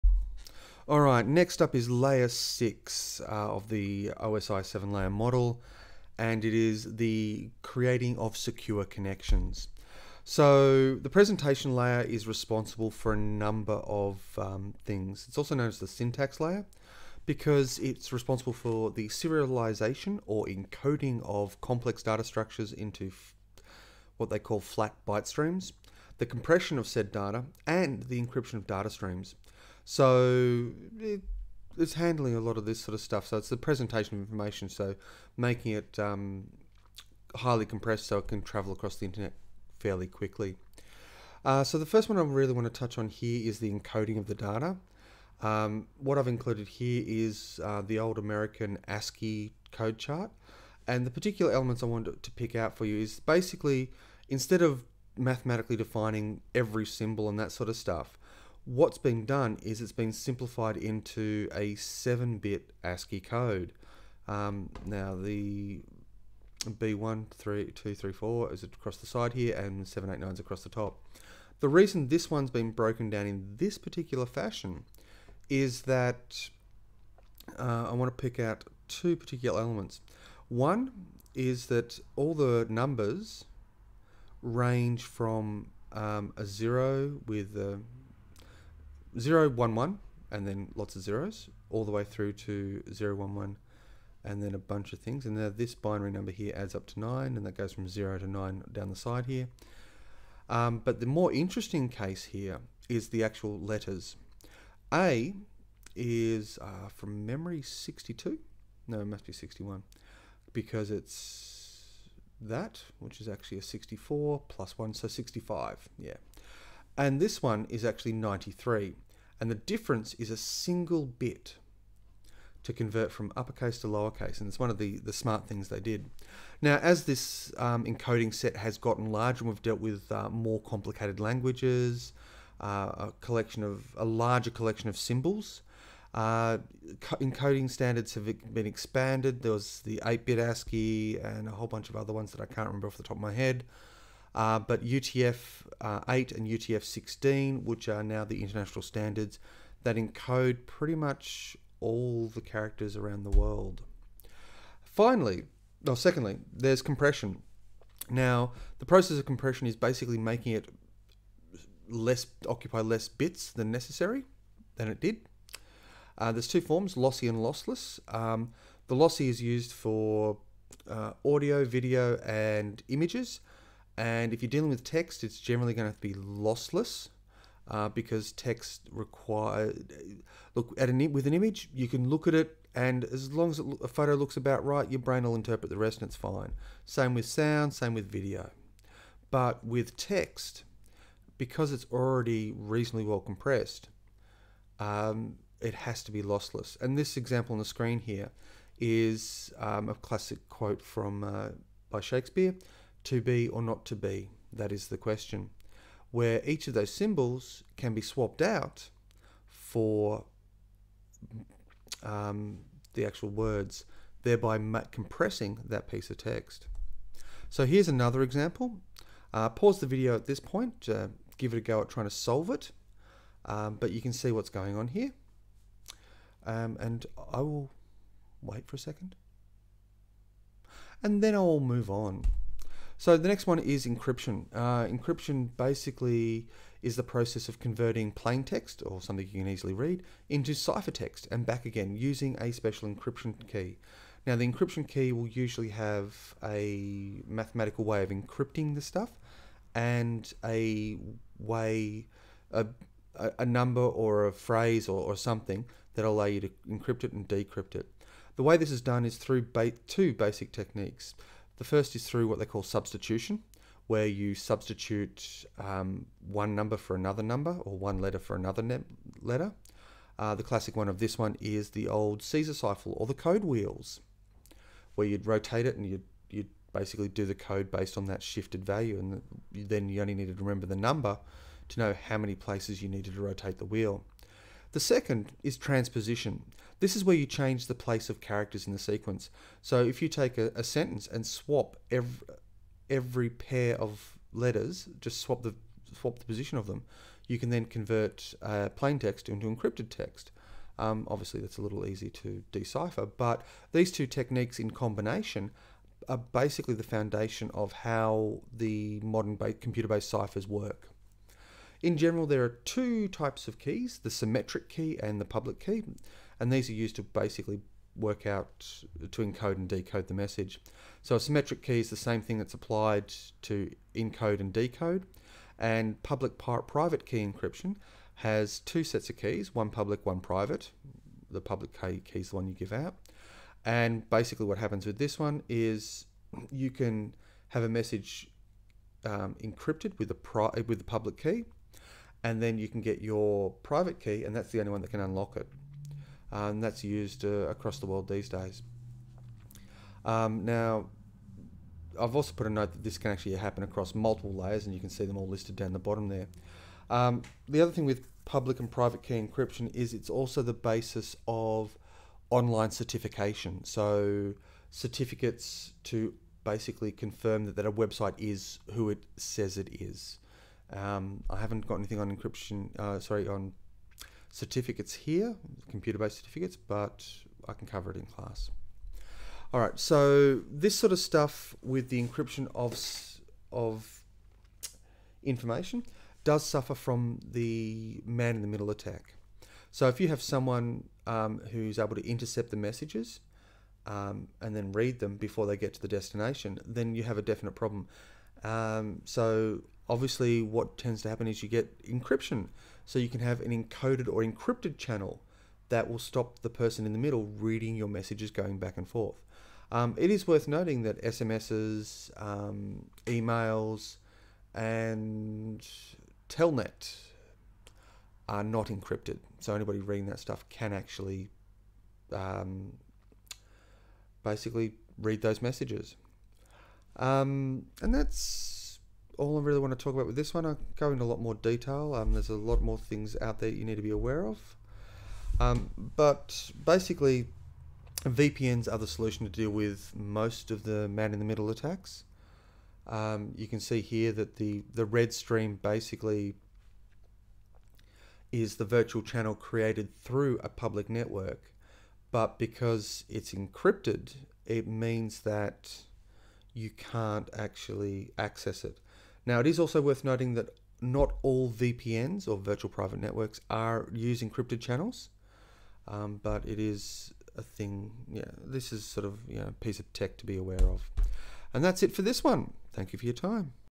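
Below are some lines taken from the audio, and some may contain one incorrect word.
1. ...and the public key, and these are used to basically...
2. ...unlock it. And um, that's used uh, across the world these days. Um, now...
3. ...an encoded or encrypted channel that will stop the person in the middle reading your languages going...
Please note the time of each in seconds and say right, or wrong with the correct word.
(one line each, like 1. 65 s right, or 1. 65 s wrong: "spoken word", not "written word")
1. 315 s right
2. 344 s right
3. 403 s wrong: "messages", not "languages".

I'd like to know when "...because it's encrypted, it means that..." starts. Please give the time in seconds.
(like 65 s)
452 s.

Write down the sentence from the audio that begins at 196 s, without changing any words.
And this example on the screen here is um, a classic quote from uh, by Shakespeare.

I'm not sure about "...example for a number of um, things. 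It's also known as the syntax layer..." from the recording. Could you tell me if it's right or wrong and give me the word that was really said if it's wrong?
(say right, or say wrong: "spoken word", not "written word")
wrong: "responsible", not "example".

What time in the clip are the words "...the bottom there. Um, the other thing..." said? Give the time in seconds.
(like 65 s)
355 s.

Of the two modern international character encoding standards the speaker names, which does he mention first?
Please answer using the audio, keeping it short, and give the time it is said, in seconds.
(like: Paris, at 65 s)
UTF-8, at 144 s.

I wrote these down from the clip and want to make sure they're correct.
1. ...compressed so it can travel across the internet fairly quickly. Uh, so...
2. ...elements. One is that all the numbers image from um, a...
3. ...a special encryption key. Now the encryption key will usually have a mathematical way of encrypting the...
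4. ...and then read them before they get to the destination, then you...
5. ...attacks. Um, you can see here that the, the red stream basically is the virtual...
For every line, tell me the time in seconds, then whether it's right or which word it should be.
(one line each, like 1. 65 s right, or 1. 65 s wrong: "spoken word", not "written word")
1. 37 s right
2. 79 s wrong: "range", not "image"
3. 242 s right
4. 394 s right
5. 441 s right.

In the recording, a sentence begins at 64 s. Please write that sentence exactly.
Um, now the B1, 3, 2, 3, 4 is across the side here and 789 is across the top.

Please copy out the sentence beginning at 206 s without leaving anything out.
Where each of those symbols can be swapped out for um, the actual words, thereby compressing that piece of text.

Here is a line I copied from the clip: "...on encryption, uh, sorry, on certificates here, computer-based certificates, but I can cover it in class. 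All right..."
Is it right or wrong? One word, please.
right.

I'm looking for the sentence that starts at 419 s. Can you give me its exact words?
So anybody reading that stuff can actually um, basically read those messages.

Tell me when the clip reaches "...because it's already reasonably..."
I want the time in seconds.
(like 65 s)
191 s.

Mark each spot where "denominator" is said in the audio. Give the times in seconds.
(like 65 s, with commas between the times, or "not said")
not said.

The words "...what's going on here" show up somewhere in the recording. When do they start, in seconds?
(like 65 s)
224 s.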